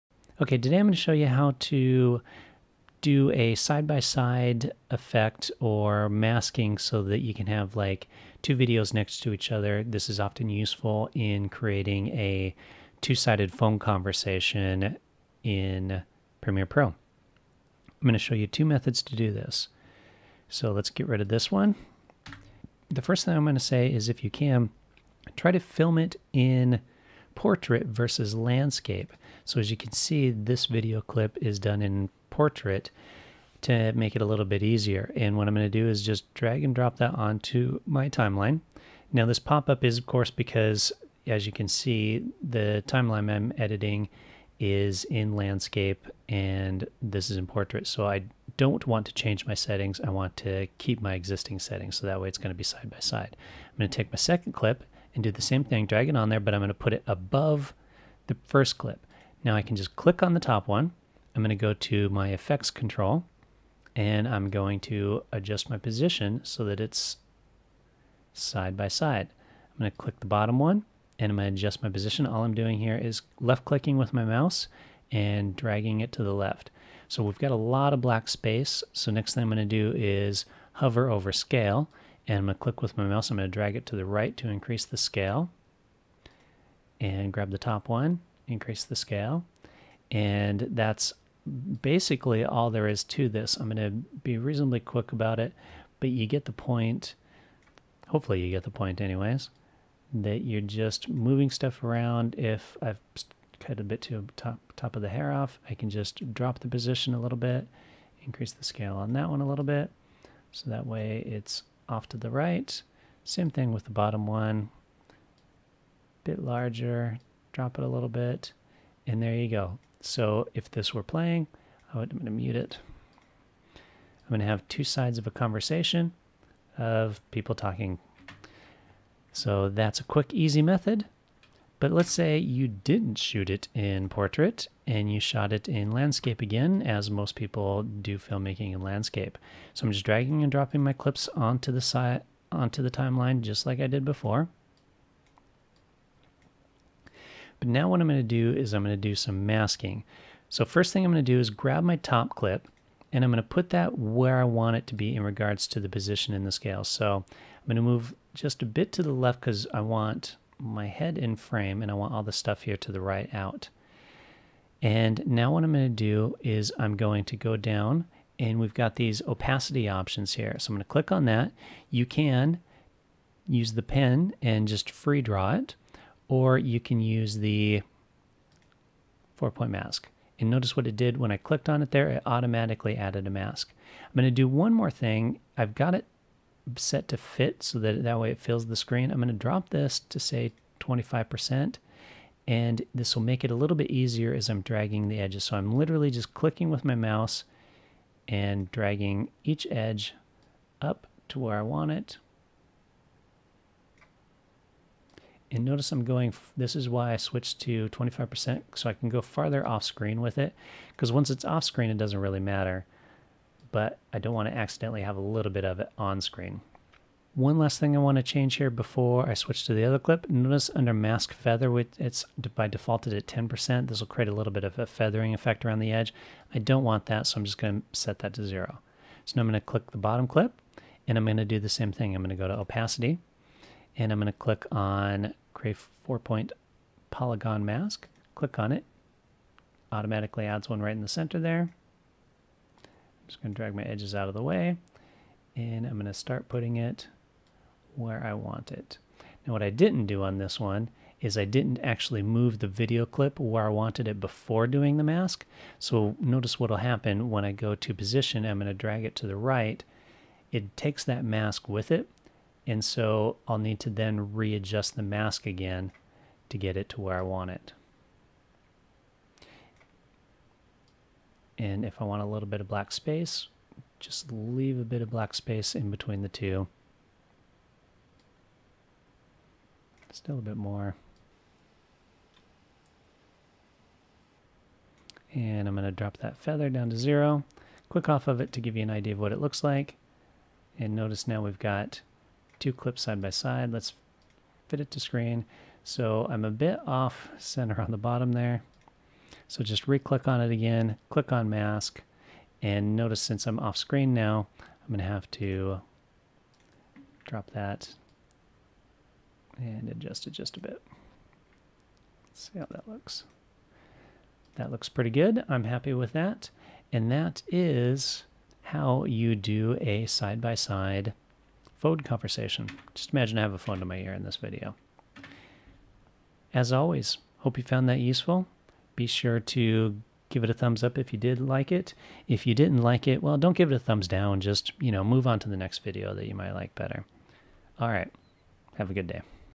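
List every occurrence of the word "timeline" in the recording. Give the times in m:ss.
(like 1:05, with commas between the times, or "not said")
0:38, 0:42, 2:22.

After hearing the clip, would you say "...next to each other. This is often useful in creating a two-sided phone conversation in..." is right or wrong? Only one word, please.
right.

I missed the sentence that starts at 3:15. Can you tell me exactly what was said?
So I'm literally just clicking with my mouse and dragging each edge up to where I want it.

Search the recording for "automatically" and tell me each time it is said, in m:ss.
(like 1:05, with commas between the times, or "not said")
3:02, 3:59.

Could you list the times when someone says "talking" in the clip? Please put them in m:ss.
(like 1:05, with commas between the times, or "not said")
2:07.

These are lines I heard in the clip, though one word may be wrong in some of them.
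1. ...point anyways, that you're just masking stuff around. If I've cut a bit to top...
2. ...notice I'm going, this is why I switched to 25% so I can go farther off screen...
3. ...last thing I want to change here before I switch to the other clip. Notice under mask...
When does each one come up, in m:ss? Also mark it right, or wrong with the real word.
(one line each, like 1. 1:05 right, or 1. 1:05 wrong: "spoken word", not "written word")
1. 1:38 wrong: "moving", not "masking"
2. 3:25 right
3. 3:37 right.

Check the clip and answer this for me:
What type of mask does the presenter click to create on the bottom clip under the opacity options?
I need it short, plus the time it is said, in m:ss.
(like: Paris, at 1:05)
four-point polygon mask, at 3:56.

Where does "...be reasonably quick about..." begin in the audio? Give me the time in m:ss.
1:34.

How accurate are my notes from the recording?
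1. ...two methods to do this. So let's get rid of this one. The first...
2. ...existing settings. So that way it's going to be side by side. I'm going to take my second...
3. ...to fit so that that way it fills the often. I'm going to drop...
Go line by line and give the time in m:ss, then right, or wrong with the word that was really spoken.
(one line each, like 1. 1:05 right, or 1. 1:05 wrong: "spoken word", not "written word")
1. 0:18 right
2. 0:51 right
3. 3:07 wrong: "screen", not "often".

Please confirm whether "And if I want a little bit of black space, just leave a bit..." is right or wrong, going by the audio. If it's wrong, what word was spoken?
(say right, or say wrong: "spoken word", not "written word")
right.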